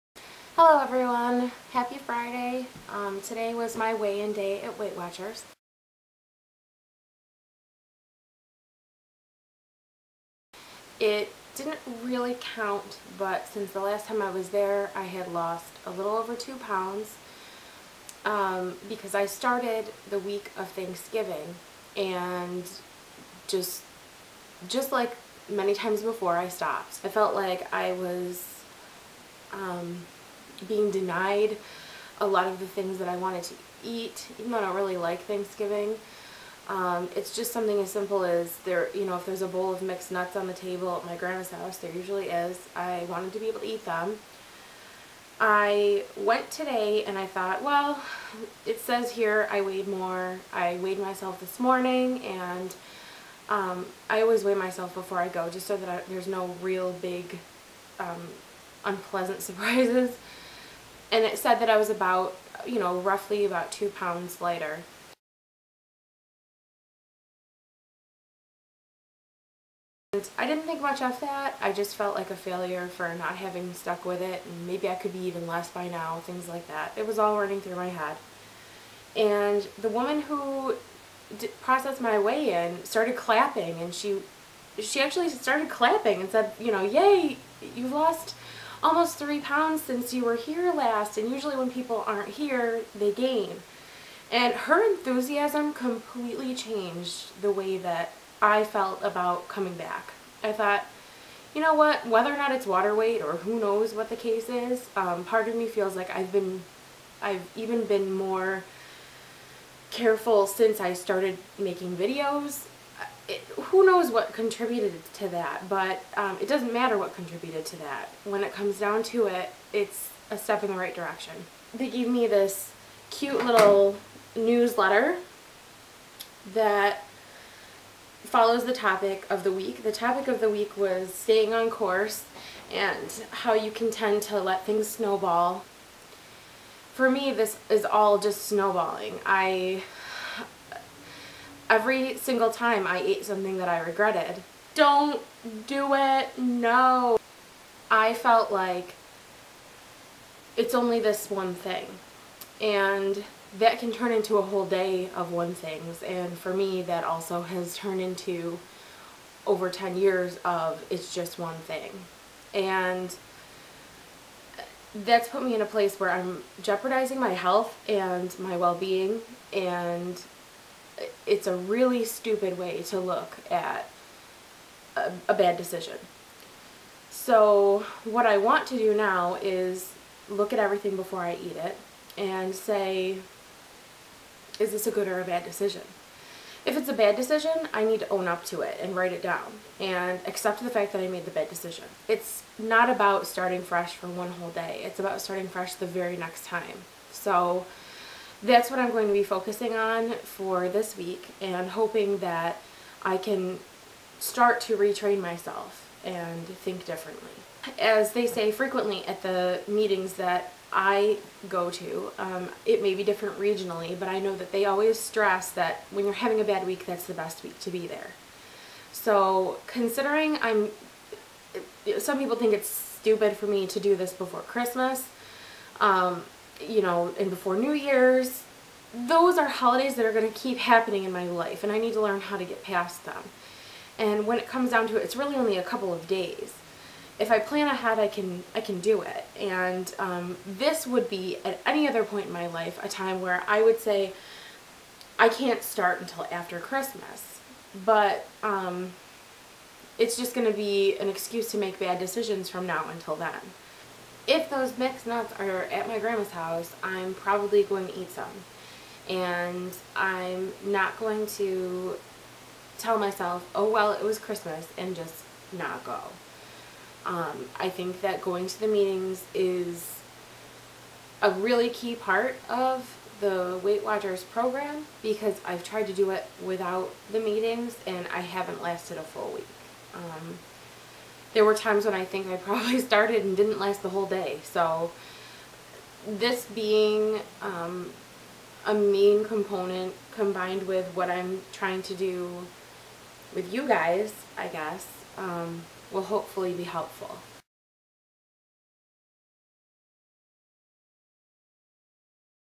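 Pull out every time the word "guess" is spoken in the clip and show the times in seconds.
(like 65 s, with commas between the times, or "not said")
294 s.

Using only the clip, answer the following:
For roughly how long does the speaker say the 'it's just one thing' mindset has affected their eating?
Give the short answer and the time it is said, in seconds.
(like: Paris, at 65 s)
over 10 years, at 159 s.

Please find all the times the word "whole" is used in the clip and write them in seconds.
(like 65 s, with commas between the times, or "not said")
154 s, 194 s, 283 s.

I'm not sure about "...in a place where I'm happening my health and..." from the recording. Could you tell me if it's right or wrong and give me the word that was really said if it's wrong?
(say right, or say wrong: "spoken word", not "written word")
wrong: "jeopardizing", not "happening".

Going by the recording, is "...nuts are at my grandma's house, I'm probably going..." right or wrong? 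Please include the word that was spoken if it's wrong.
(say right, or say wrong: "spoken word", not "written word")
right.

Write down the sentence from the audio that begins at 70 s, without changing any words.
And I didn't think much of that.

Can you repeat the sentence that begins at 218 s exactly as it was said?
So considering I'm, some people think it's stupid for me to do this before Christmas, um, you know, and before New Year's.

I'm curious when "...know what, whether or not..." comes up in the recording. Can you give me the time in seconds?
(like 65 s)
101 s.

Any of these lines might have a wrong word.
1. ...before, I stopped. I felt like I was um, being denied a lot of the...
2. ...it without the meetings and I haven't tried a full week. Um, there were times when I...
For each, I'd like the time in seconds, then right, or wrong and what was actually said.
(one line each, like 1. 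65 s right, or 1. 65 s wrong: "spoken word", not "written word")
1. 26 s right
2. 276 s wrong: "lasted", not "tried".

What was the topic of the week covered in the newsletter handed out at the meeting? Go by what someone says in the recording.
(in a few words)
staying on course.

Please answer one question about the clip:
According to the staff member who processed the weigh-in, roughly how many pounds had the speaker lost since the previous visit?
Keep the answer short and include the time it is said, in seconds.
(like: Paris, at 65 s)
almost 3 pounds, at 88 s.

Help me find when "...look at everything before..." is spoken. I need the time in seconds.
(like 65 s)
180 s.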